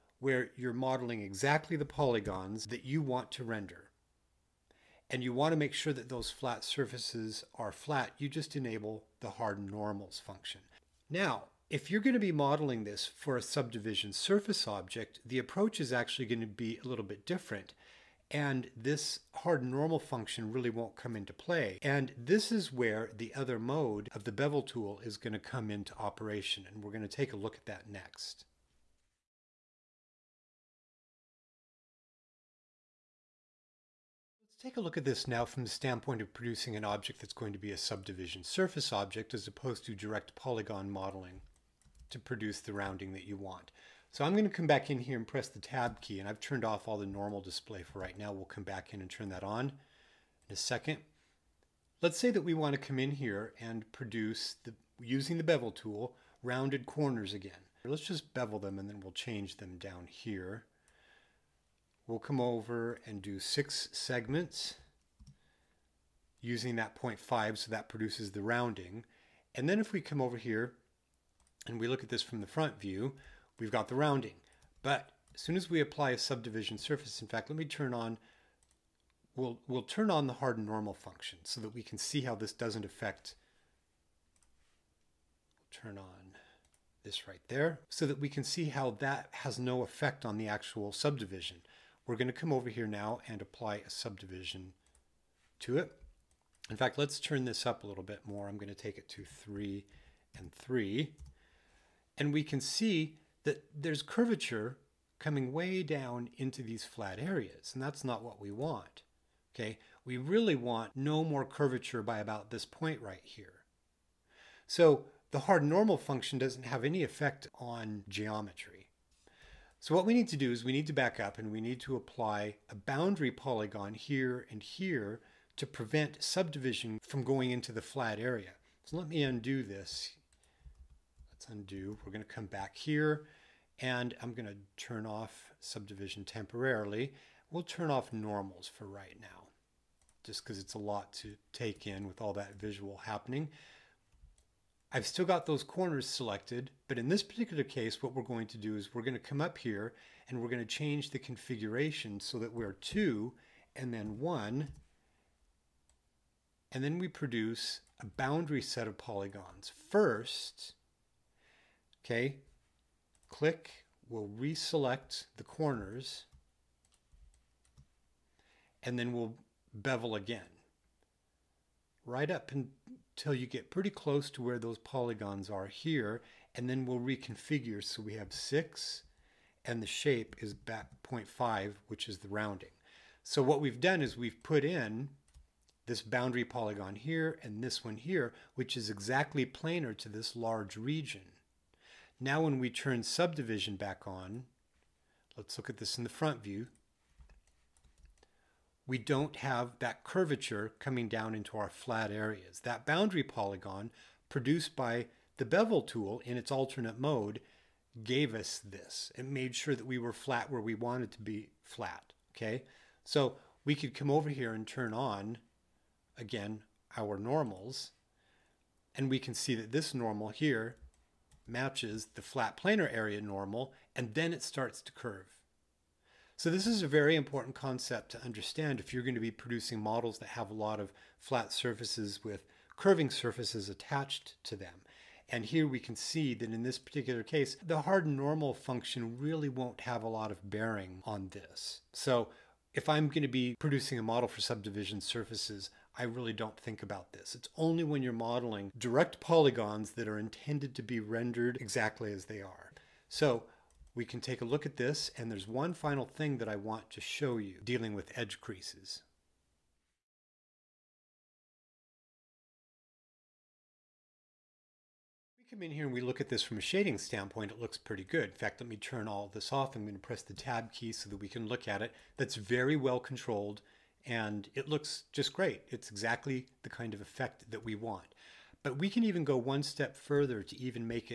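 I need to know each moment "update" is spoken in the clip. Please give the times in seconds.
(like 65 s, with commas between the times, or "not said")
not said.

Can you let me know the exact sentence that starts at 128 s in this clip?
So let me undo this Let's undo.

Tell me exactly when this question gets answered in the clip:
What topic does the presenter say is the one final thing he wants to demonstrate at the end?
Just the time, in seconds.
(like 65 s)
258 s.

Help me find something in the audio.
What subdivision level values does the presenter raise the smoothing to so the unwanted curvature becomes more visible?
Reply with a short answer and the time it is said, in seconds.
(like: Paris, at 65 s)
3 and 3, at 99 s.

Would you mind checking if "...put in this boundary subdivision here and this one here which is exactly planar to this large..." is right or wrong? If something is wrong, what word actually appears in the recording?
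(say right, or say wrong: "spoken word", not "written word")
wrong: "polygon", not "subdivision".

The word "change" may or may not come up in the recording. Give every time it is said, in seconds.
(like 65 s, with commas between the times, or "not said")
59 s, 150 s.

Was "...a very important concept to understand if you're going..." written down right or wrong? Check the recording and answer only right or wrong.
right.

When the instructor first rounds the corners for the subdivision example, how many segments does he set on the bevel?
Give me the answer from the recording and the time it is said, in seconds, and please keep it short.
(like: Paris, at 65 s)
6, at 63 s.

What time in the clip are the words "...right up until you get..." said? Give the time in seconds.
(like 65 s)
172 s.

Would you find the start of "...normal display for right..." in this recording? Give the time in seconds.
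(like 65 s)
47 s.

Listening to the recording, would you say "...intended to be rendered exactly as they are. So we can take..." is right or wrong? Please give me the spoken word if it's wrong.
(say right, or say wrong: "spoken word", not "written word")
right.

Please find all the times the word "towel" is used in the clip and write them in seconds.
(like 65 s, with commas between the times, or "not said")
not said.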